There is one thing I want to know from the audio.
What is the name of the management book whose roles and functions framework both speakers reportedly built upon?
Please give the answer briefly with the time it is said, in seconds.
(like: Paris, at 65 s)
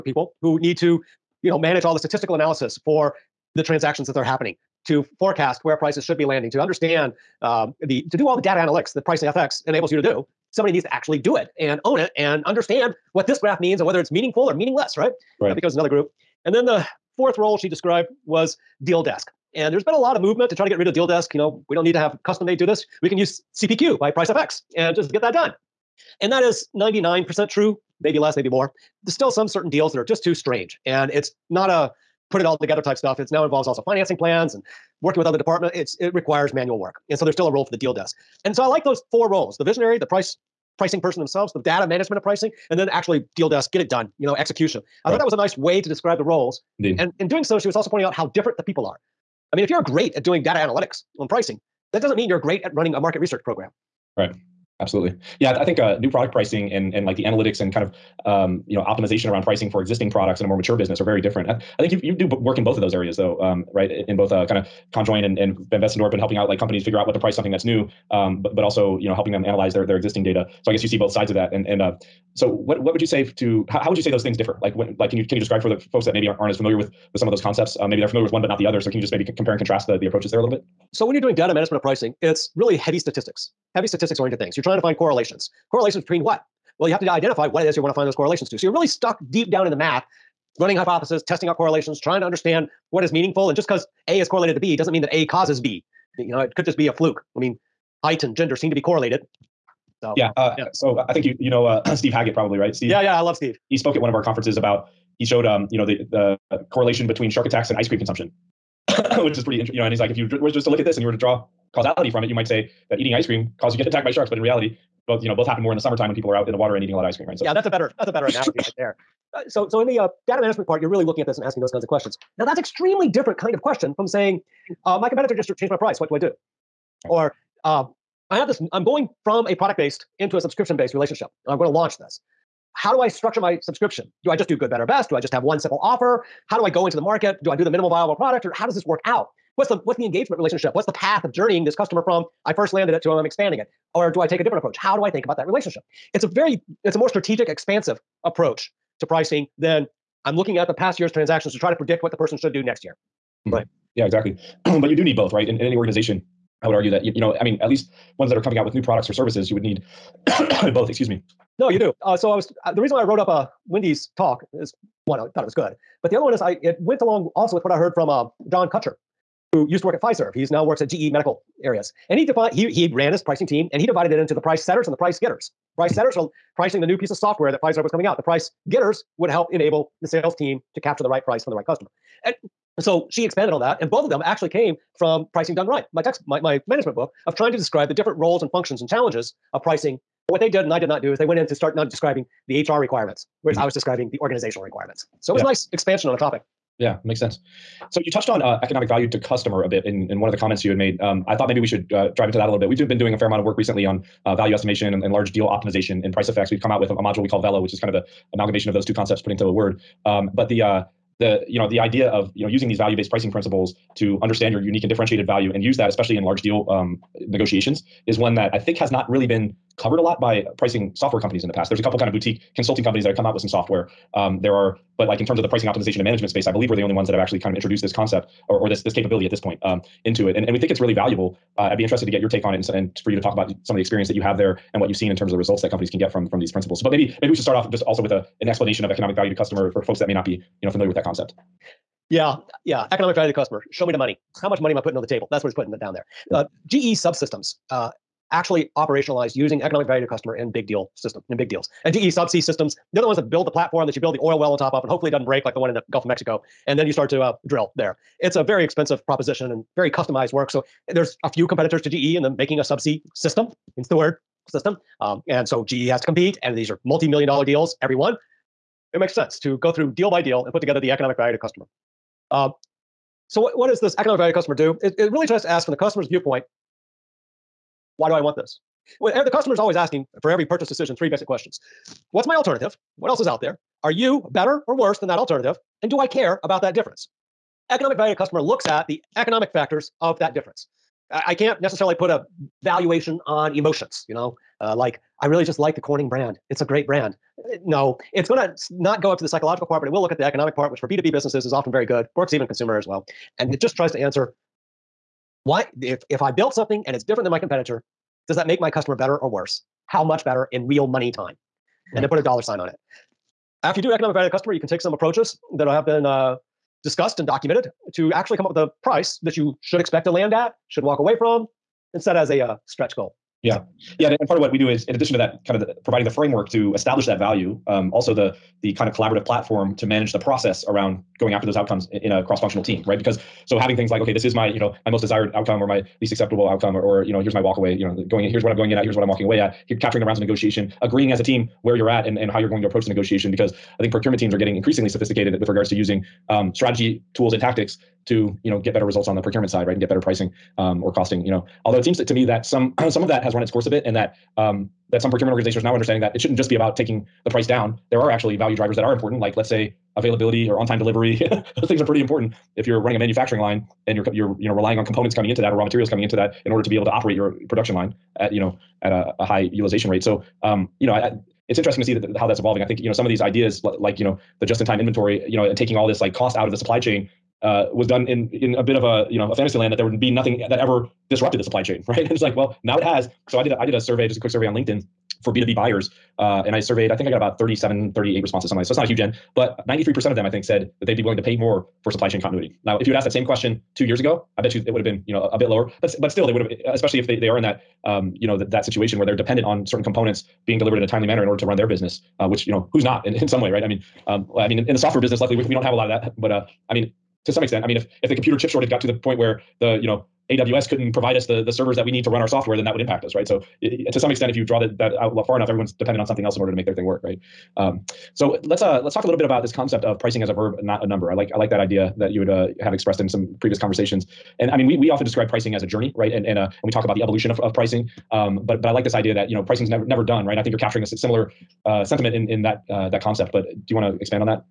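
Pricing Done Right, at 185 s.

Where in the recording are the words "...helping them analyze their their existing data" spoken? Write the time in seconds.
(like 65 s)
69 s.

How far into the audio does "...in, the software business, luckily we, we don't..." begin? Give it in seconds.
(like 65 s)
404 s.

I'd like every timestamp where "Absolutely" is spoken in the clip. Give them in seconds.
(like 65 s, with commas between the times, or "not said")
54 s.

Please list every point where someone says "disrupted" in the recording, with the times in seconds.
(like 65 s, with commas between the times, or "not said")
381 s.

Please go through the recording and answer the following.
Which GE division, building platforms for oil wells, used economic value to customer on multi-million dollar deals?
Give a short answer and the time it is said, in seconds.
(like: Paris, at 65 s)
GE subsea systems, at 251 s.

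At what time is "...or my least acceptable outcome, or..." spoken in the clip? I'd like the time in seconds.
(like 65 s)
335 s.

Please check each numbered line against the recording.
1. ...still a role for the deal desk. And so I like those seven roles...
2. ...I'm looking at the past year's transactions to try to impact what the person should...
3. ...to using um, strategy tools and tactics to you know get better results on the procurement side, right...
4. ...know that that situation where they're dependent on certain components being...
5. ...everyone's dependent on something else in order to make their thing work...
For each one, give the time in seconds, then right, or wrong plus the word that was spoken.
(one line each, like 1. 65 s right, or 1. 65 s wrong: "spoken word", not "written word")
1. 37 s wrong: "four", not "seven"
2. 150 s wrong: "predict", not "impact"
3. 345 s right
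4. 398 s right
5. 415 s right.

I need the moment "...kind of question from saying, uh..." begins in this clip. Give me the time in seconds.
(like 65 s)
123 s.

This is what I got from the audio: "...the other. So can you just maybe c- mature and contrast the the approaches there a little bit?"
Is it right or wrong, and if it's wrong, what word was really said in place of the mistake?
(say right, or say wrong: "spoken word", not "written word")
wrong: "compare", not "mature".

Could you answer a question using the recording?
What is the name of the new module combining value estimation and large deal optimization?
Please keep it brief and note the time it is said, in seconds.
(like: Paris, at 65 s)
Velo, at 207 s.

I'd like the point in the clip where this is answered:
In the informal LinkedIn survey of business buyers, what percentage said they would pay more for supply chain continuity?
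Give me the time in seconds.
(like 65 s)
389 s.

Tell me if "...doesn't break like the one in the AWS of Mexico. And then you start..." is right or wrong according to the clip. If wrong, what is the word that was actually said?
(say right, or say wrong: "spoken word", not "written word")
wrong: "Gulf", not "AWS".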